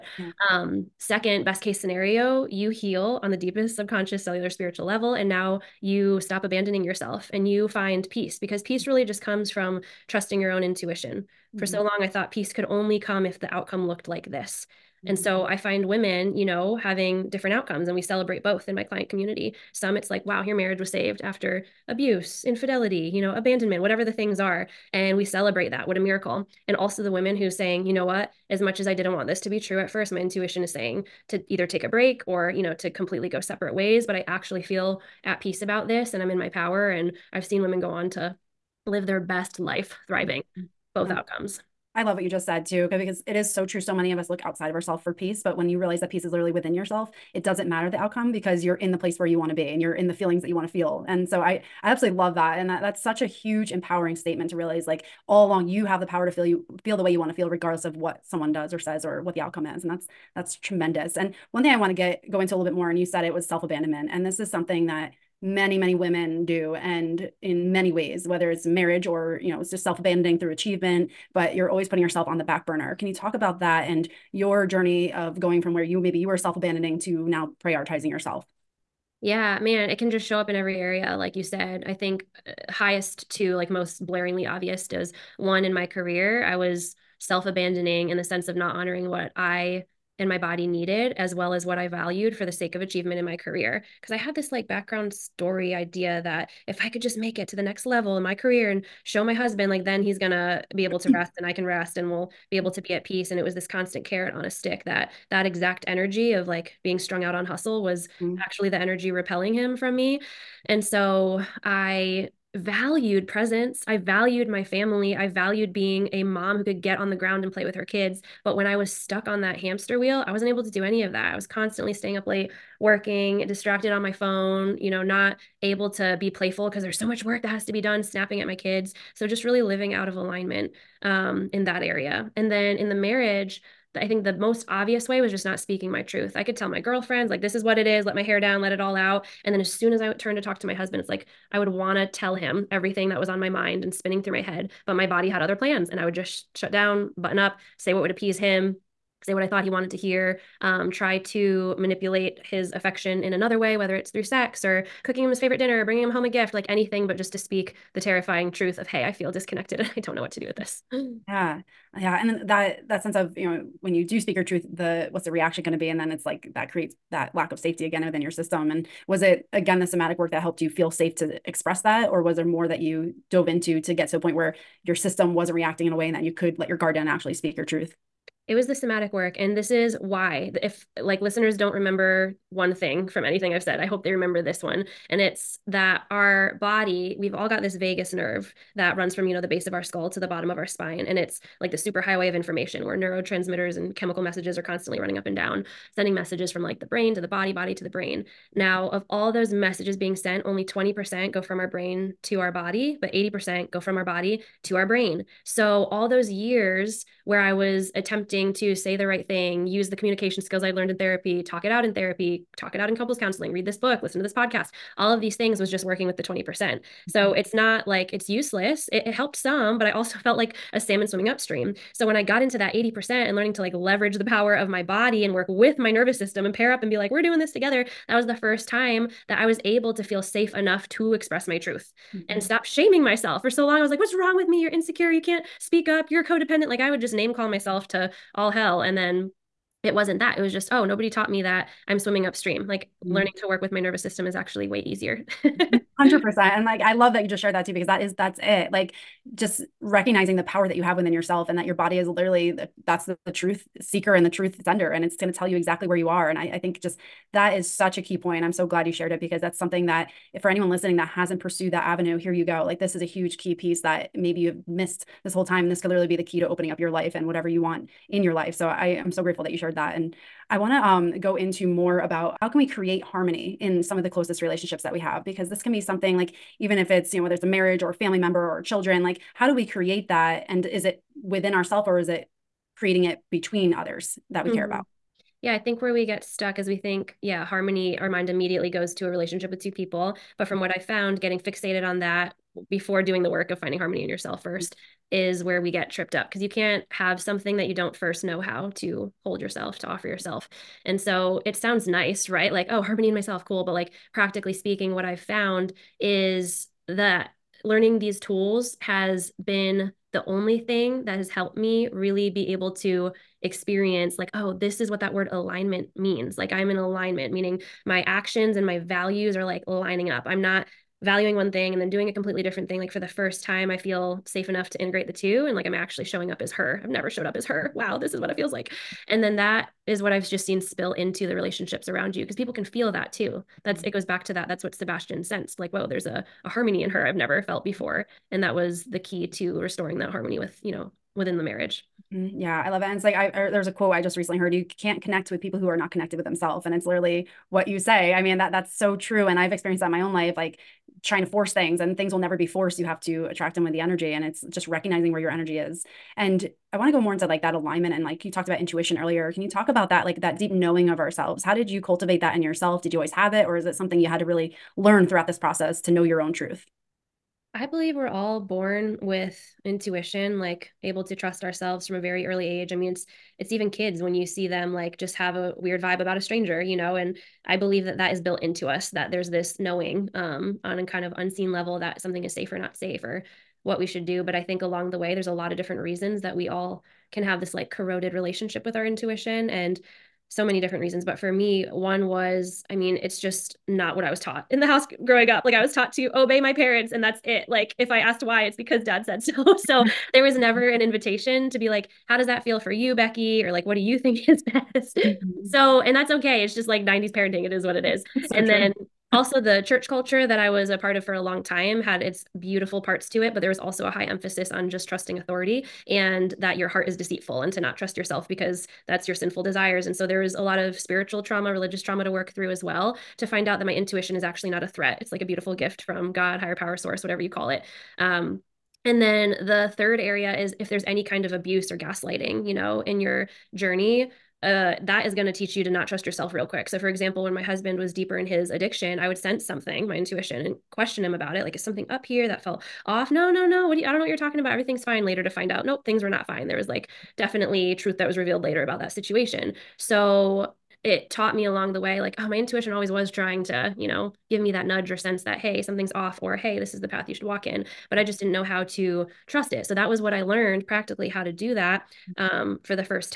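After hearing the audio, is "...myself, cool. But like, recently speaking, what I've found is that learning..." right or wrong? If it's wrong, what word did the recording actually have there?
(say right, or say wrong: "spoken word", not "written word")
wrong: "practically", not "recently".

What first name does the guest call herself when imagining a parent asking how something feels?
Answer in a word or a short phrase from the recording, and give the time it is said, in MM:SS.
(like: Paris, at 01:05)
Becky, at 06:42.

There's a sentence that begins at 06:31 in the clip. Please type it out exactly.
But for me, one was I mean, it's just not what I was taught in the house growing up.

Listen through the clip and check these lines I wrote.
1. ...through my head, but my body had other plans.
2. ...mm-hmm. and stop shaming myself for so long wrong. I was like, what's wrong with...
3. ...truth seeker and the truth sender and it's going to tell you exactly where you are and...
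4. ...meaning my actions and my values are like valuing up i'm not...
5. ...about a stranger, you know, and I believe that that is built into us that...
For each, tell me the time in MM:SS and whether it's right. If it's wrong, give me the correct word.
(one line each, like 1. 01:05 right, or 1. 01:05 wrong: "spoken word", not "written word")
1. 02:24 right
2. 03:52 right
3. 04:13 right
4. 05:17 wrong: "lining", not "valuing"
5. 06:16 right.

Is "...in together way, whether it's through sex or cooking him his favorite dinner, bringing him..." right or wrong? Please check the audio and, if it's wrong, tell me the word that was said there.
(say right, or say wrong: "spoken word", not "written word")
wrong: "another", not "together".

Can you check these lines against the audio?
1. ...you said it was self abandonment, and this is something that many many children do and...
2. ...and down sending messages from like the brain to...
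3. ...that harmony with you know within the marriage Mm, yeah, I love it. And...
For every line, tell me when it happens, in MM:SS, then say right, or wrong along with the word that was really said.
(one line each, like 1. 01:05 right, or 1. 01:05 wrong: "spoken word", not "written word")
1. 01:02 wrong: "women", not "children"
2. 03:15 right
3. 05:39 right.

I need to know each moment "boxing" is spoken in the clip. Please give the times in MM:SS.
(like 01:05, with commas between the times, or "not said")
not said.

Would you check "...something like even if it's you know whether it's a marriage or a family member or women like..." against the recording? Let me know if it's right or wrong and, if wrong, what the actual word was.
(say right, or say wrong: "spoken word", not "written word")
wrong: "children", not "women".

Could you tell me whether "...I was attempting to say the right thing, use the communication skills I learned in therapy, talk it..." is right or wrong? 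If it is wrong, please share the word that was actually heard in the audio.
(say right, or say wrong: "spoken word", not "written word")
right.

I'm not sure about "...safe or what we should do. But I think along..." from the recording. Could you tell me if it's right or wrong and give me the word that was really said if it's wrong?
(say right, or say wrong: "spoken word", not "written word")
right.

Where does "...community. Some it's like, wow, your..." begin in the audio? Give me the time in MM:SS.
00:19.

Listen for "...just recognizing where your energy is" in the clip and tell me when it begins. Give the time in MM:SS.
05:54.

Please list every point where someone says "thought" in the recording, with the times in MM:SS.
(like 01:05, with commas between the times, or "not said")
00:12, 02:29.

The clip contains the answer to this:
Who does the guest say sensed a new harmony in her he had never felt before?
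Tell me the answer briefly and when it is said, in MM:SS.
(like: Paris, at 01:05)
Sebastian, at 05:34.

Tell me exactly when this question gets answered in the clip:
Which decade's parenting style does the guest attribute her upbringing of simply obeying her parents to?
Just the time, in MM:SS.
06:46.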